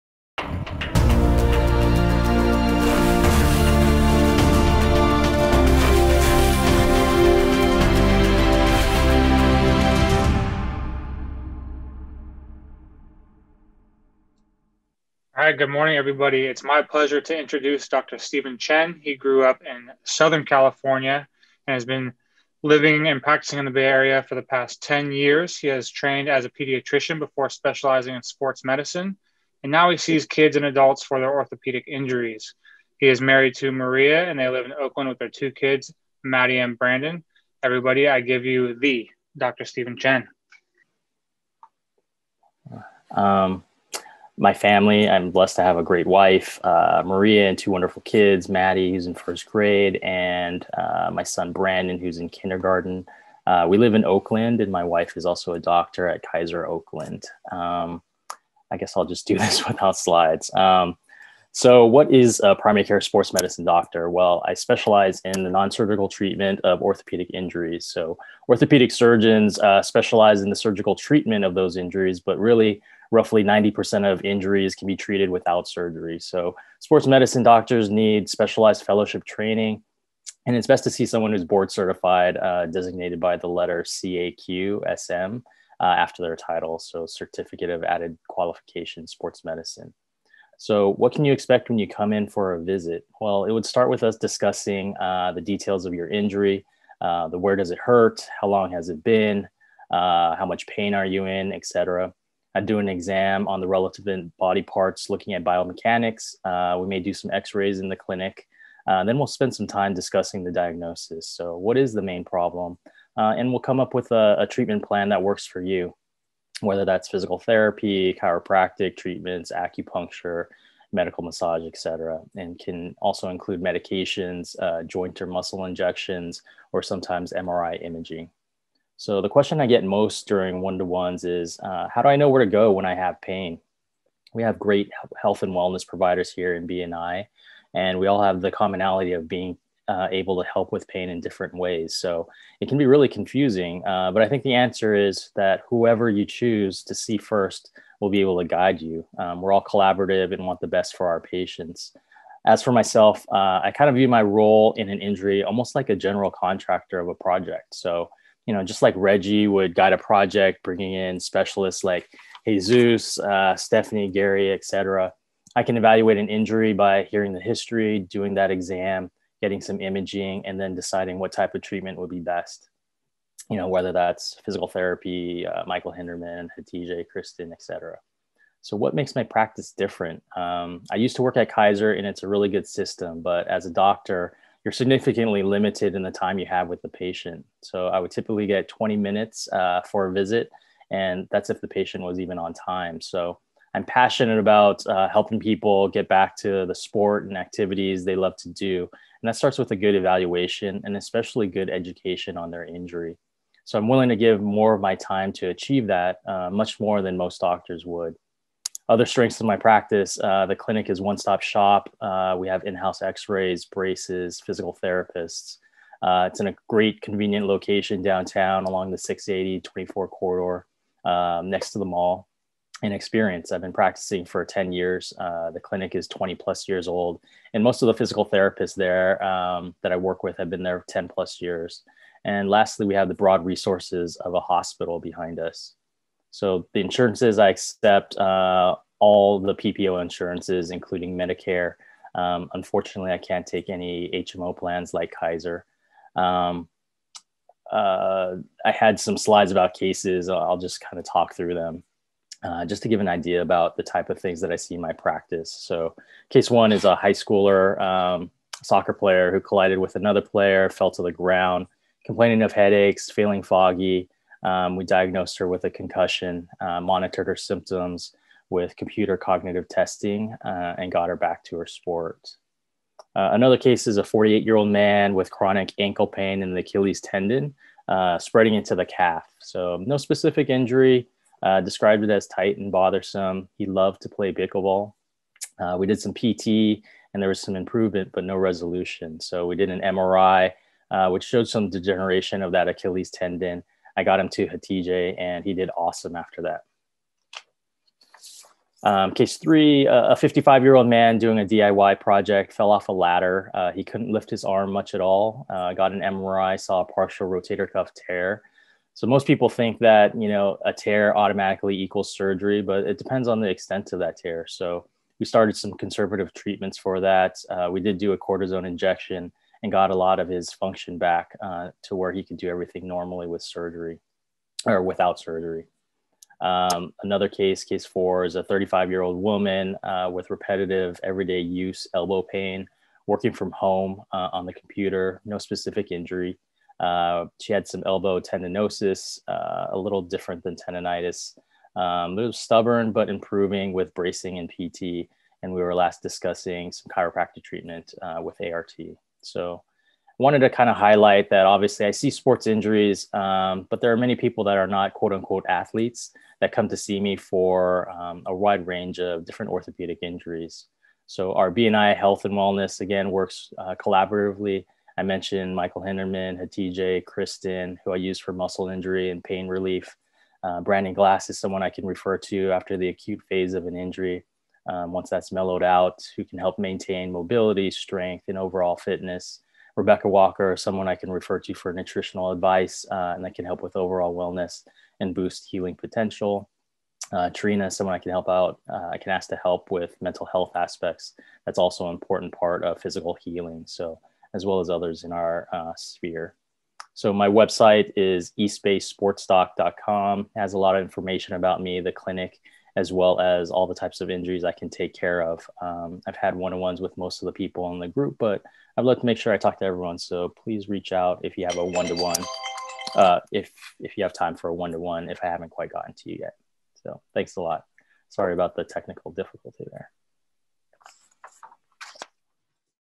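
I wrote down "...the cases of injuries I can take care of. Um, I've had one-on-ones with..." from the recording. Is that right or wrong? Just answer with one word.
wrong.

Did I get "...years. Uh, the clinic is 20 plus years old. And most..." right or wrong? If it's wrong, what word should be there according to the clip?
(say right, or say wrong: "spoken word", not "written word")
right.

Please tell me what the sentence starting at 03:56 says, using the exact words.
So the insurances I accept, uh, all the PPO insurances, including Medicare.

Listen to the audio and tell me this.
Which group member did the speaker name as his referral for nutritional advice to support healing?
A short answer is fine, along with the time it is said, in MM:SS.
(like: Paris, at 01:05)
Rebecca Walker, at 06:19.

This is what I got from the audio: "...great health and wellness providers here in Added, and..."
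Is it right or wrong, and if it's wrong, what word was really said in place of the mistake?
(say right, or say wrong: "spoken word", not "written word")
wrong: "BNI", not "Added".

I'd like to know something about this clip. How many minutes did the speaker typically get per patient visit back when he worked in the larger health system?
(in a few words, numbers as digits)
20 minutes.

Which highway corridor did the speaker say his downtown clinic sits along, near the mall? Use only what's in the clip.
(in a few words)
680/24.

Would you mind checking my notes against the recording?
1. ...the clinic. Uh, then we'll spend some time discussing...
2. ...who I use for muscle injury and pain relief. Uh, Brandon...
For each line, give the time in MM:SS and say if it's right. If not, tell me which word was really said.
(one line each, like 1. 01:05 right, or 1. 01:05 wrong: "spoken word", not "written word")
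1. 01:47 right
2. 06:07 right.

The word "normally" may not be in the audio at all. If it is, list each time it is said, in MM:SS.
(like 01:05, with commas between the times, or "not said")
05:22.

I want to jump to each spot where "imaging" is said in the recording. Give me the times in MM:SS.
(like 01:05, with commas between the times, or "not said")
02:07, 02:49.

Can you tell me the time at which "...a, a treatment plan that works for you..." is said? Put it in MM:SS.
01:54.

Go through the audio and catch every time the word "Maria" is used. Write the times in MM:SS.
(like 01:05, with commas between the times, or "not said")
00:33, 00:47.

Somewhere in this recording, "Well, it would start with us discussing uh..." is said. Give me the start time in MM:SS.
01:33.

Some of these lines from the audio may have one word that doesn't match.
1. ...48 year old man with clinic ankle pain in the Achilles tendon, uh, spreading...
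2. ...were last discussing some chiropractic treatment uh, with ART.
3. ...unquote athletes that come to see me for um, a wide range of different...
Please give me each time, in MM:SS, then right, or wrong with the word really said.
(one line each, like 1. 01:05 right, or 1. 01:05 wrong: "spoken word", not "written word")
1. 04:34 wrong: "chronic", not "clinic"
2. 05:45 right
3. 05:55 right.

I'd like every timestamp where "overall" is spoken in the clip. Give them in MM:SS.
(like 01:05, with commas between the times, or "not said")
06:18, 06:23.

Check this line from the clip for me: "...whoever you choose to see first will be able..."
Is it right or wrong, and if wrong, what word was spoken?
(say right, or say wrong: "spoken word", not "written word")
right.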